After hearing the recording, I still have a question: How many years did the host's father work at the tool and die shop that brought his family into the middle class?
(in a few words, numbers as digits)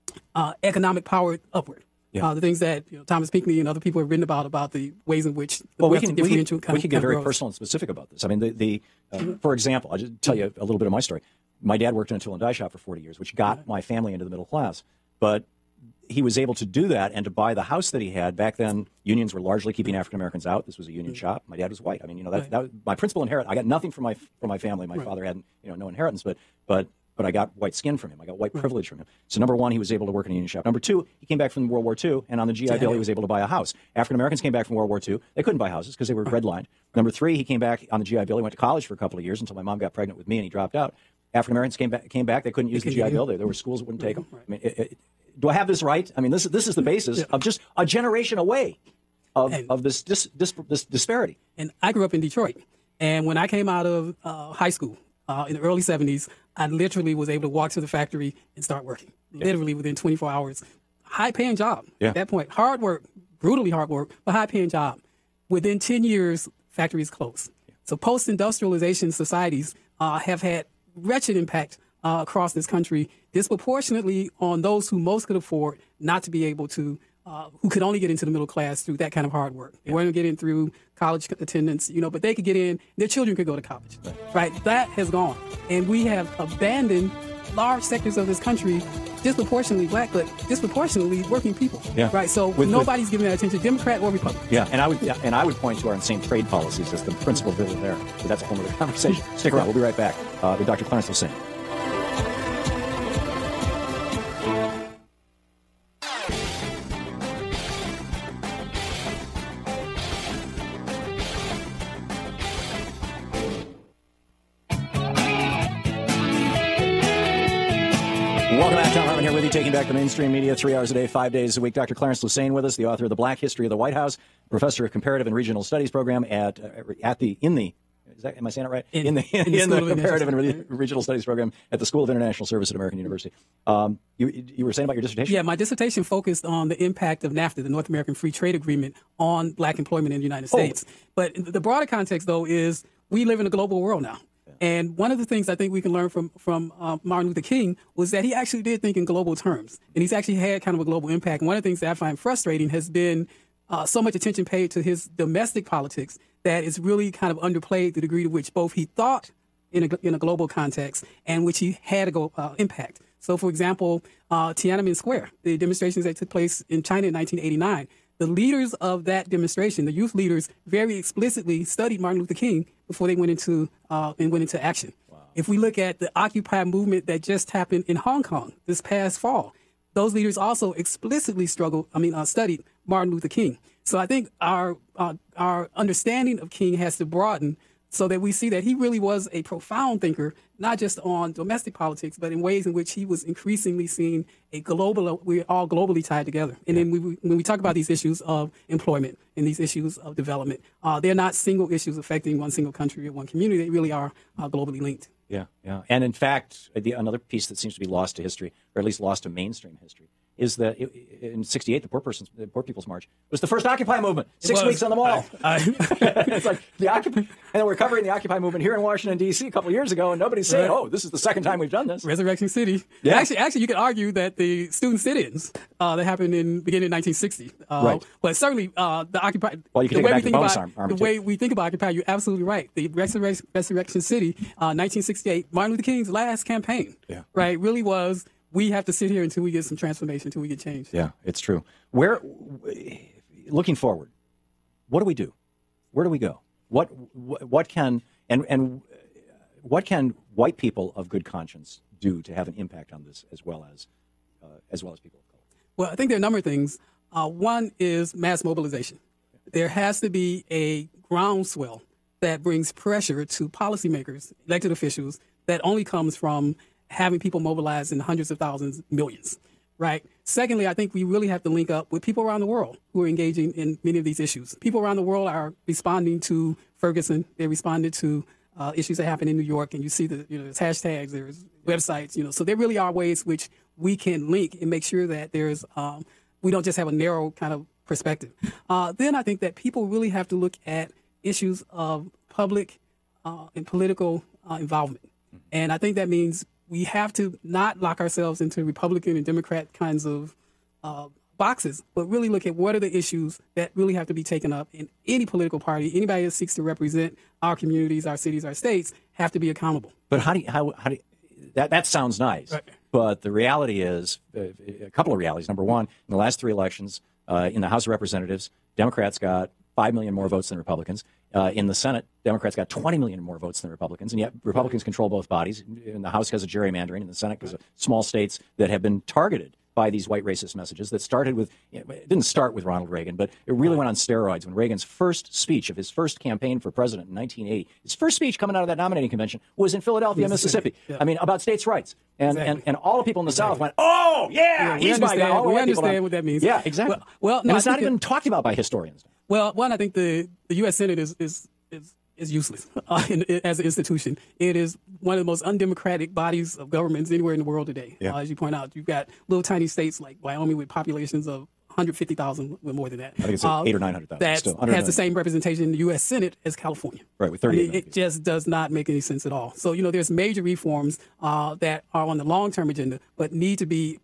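40 years.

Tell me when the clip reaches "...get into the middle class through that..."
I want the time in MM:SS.
01:17.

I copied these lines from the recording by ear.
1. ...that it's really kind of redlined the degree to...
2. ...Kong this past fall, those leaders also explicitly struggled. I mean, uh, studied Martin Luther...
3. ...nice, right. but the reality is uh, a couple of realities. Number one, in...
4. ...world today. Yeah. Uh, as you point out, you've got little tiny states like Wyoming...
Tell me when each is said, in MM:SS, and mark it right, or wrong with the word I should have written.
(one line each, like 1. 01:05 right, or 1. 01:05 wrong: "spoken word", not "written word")
1. 02:36 wrong: "underplayed", not "redlined"
2. 02:58 right
3. 05:12 right
4. 05:57 right.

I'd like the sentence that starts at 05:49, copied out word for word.
Well, one, I think the the U.S.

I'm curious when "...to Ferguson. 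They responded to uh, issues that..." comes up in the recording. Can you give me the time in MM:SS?
04:36.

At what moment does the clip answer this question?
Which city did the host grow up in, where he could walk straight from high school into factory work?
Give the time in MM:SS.
00:52.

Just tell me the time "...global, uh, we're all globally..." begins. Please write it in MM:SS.
03:14.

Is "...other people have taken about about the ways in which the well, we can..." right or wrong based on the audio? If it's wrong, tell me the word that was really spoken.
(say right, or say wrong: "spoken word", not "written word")
wrong: "written", not "taken".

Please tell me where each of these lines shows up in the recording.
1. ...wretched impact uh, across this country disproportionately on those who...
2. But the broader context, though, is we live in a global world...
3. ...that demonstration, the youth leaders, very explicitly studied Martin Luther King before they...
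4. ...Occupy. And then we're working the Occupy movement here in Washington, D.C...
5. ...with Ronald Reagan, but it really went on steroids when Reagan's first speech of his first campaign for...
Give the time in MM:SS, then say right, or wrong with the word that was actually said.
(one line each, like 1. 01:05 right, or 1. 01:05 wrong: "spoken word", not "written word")
1. 01:10 right
2. 02:21 right
3. 02:49 right
4. 03:36 wrong: "covering", not "working"
5. 05:32 right.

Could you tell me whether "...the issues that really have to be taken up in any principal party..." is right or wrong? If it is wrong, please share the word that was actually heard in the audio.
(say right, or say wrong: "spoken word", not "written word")
wrong: "political", not "principal".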